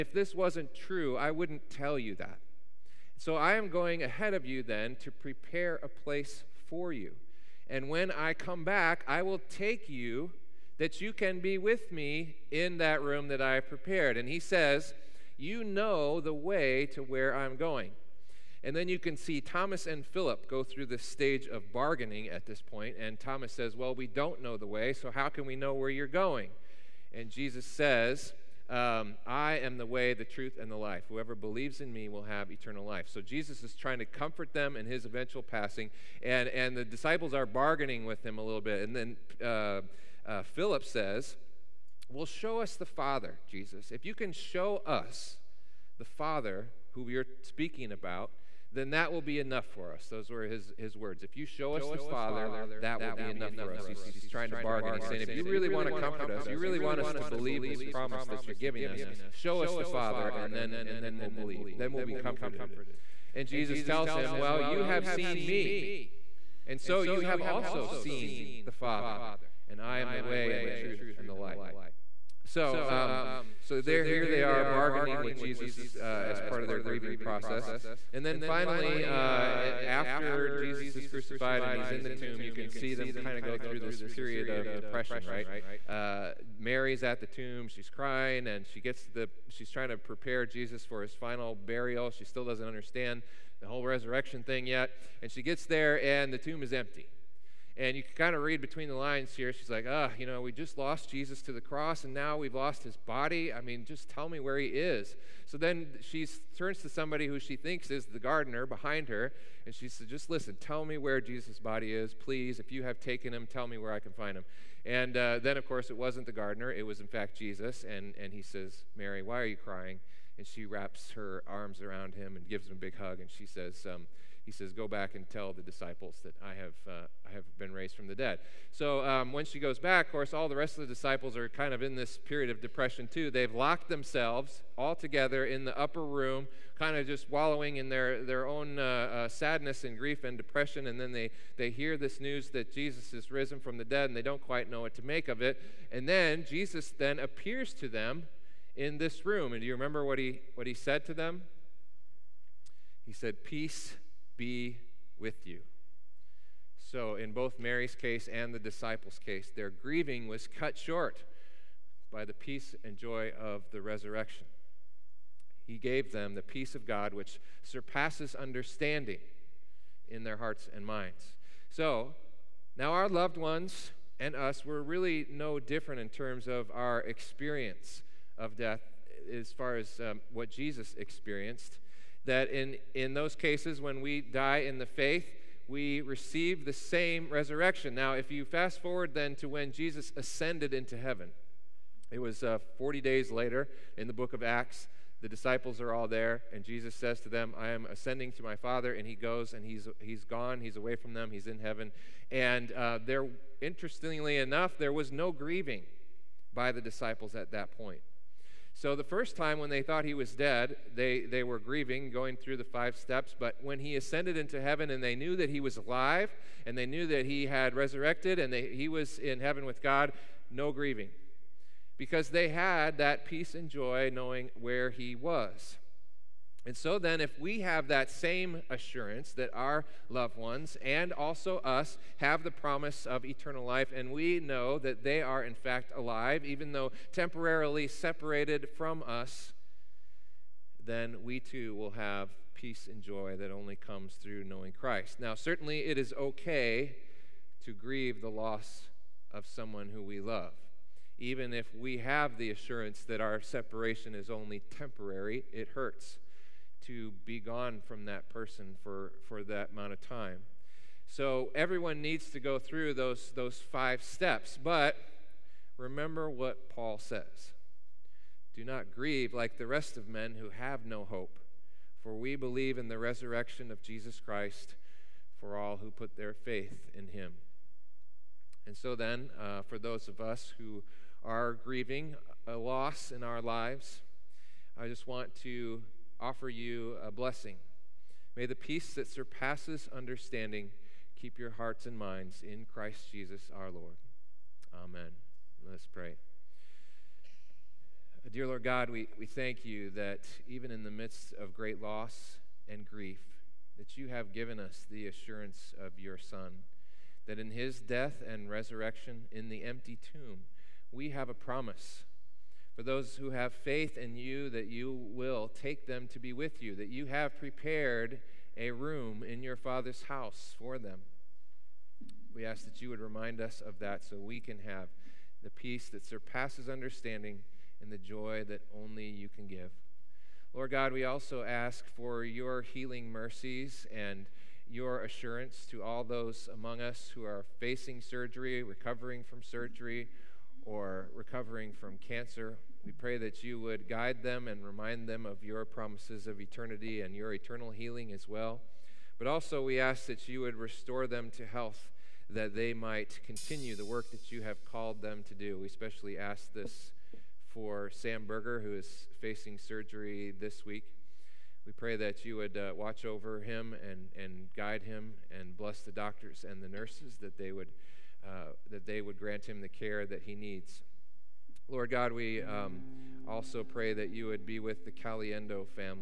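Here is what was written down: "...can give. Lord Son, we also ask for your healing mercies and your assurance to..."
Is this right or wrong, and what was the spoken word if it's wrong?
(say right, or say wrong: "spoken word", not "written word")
wrong: "God", not "Son".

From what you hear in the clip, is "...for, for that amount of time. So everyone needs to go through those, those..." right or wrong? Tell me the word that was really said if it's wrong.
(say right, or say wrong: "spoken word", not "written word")
right.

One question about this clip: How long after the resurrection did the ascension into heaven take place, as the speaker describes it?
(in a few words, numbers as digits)
40 days.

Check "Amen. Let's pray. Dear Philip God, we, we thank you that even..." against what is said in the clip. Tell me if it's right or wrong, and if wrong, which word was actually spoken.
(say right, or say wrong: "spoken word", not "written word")
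wrong: "Lord", not "Philip".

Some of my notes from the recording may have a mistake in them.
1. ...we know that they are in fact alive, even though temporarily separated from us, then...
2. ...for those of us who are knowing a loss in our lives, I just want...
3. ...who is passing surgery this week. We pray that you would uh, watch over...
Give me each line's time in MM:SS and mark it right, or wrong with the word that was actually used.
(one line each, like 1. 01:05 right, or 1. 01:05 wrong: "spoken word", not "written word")
1. 03:54 right
2. 04:39 wrong: "grieving", not "knowing"
3. 05:58 wrong: "facing", not "passing".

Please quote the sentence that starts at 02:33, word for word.
He said, Peace be with you.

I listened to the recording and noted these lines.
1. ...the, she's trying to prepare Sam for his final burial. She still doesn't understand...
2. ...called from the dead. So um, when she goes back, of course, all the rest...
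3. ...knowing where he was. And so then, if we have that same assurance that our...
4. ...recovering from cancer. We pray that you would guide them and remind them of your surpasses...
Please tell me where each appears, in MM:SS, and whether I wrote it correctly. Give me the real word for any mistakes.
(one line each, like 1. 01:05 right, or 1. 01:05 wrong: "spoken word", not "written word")
1. 01:29 wrong: "Jesus", not "Sam"
2. 02:07 wrong: "raised", not "called"
3. 03:44 right
4. 05:41 wrong: "promises", not "surpasses".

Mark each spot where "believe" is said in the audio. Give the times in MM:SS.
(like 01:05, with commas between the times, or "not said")
00:31, 00:57, 01:01, 04:32.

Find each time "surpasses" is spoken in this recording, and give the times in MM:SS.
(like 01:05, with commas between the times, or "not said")
02:47, 04:49, 05:26.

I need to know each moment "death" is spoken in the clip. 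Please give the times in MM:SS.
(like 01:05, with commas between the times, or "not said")
02:58, 05:07.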